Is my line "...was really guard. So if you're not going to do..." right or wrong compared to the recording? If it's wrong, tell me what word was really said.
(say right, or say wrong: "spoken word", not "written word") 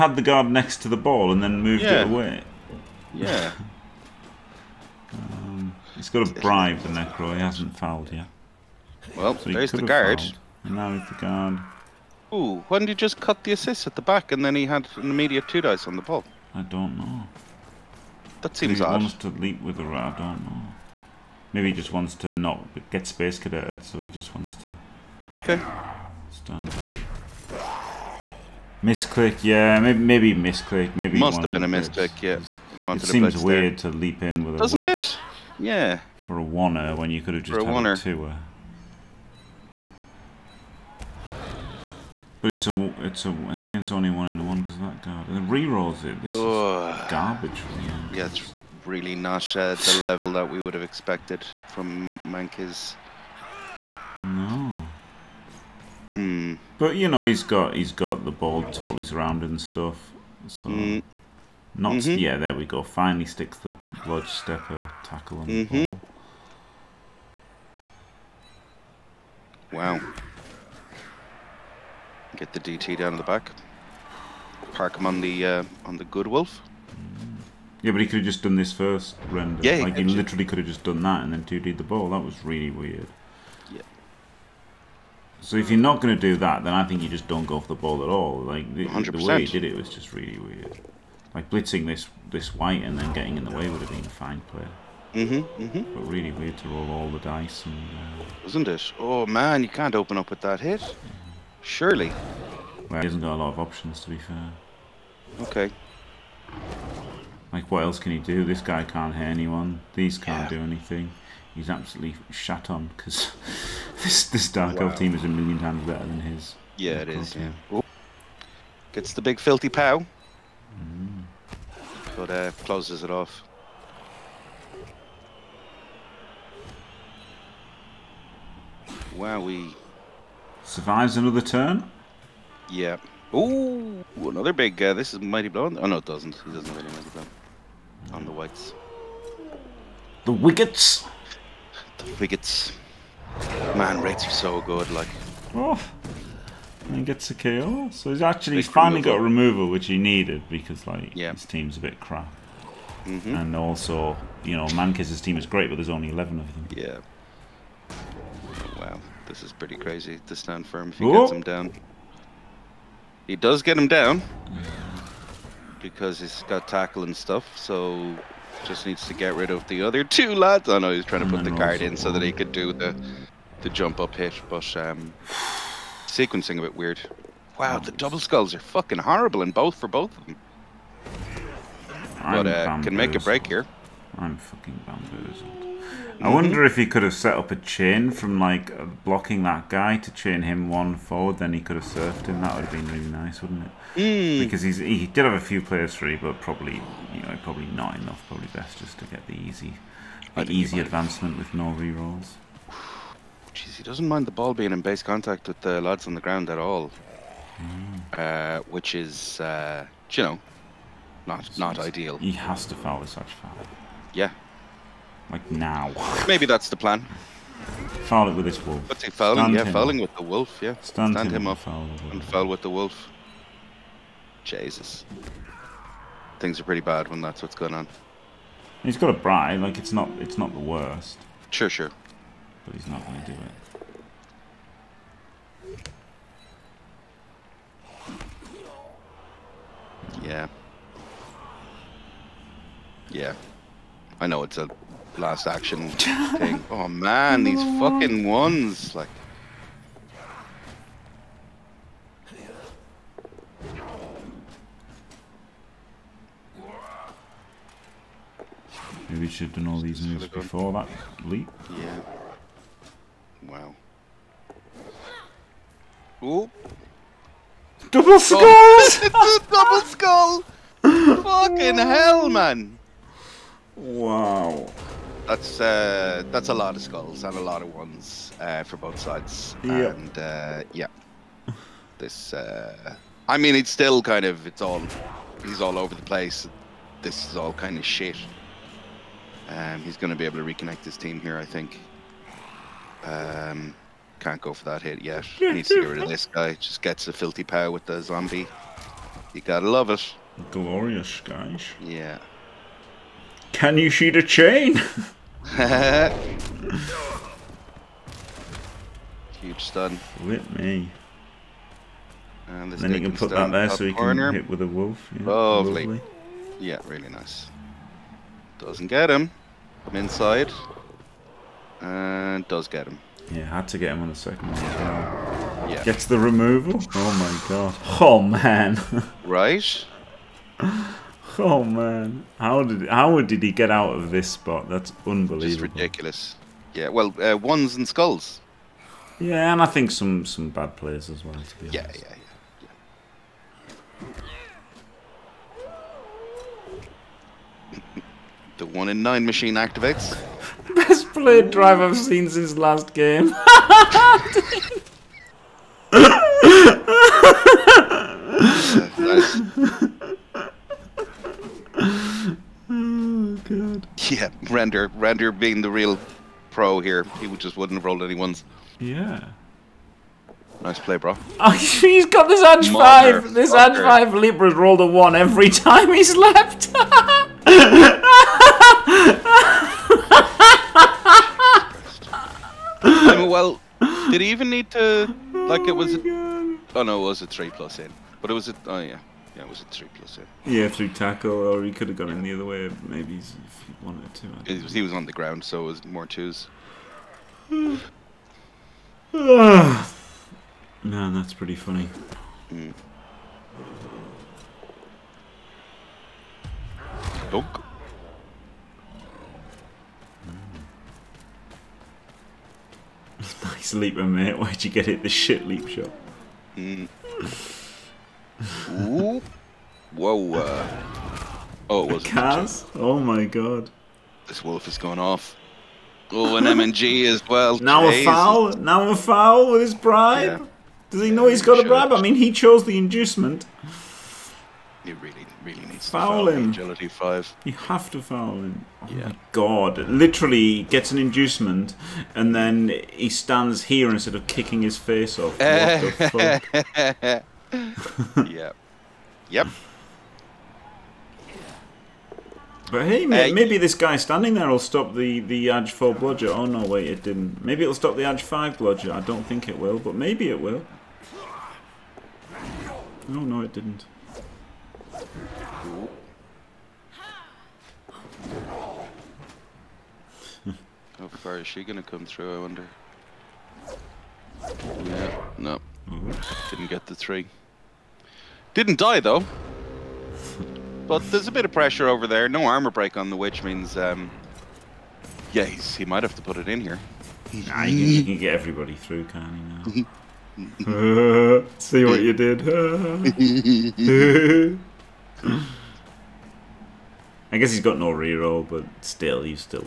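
wrong: "weird", not "guard".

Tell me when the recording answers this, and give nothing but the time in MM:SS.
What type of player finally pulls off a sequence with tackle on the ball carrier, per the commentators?
01:04.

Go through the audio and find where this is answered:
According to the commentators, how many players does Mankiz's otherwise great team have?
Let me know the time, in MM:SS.
02:36.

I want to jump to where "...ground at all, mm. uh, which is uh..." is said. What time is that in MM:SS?
03:26.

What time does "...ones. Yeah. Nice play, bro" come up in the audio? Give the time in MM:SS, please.
06:08.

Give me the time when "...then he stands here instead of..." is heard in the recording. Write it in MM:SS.
07:22.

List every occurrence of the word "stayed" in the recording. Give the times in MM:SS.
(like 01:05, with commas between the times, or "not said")
not said.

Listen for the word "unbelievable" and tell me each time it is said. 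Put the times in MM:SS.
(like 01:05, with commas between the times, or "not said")
05:35.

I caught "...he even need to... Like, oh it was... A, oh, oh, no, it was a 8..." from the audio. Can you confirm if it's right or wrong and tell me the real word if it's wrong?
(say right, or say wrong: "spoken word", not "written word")
wrong: "3", not "8".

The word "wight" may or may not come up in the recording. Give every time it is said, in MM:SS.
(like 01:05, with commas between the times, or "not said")
01:32, 02:18.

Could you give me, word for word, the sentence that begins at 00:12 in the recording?
Ooh, why didn't he just cut the assist at the back and then he had an immediate two dice on the ball?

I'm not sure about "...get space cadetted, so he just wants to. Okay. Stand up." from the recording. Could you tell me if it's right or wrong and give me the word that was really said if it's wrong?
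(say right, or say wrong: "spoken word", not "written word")
right.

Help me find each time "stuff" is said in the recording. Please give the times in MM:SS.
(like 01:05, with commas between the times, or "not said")
00:59, 02:47.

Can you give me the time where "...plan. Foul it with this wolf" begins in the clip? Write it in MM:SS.
03:36.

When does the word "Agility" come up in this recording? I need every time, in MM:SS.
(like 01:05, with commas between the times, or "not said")
07:16.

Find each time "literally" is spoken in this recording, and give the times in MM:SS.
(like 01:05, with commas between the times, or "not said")
01:20, 07:19.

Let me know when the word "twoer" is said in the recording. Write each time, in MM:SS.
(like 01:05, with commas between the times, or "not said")
00:37.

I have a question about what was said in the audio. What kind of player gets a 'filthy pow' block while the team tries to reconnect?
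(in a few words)
zombie.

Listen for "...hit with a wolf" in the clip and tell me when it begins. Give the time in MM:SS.
05:14.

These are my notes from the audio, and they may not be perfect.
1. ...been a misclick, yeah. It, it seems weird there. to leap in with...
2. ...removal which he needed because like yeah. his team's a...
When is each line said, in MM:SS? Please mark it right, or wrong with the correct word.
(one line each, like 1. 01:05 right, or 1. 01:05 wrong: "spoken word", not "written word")
1. 00:31 right
2. 02:29 right.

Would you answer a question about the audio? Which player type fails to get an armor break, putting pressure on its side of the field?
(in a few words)
witch.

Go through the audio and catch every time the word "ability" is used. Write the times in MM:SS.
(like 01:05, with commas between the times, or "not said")
not said.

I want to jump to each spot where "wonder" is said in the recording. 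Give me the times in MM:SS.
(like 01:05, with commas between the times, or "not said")
03:06, 07:52.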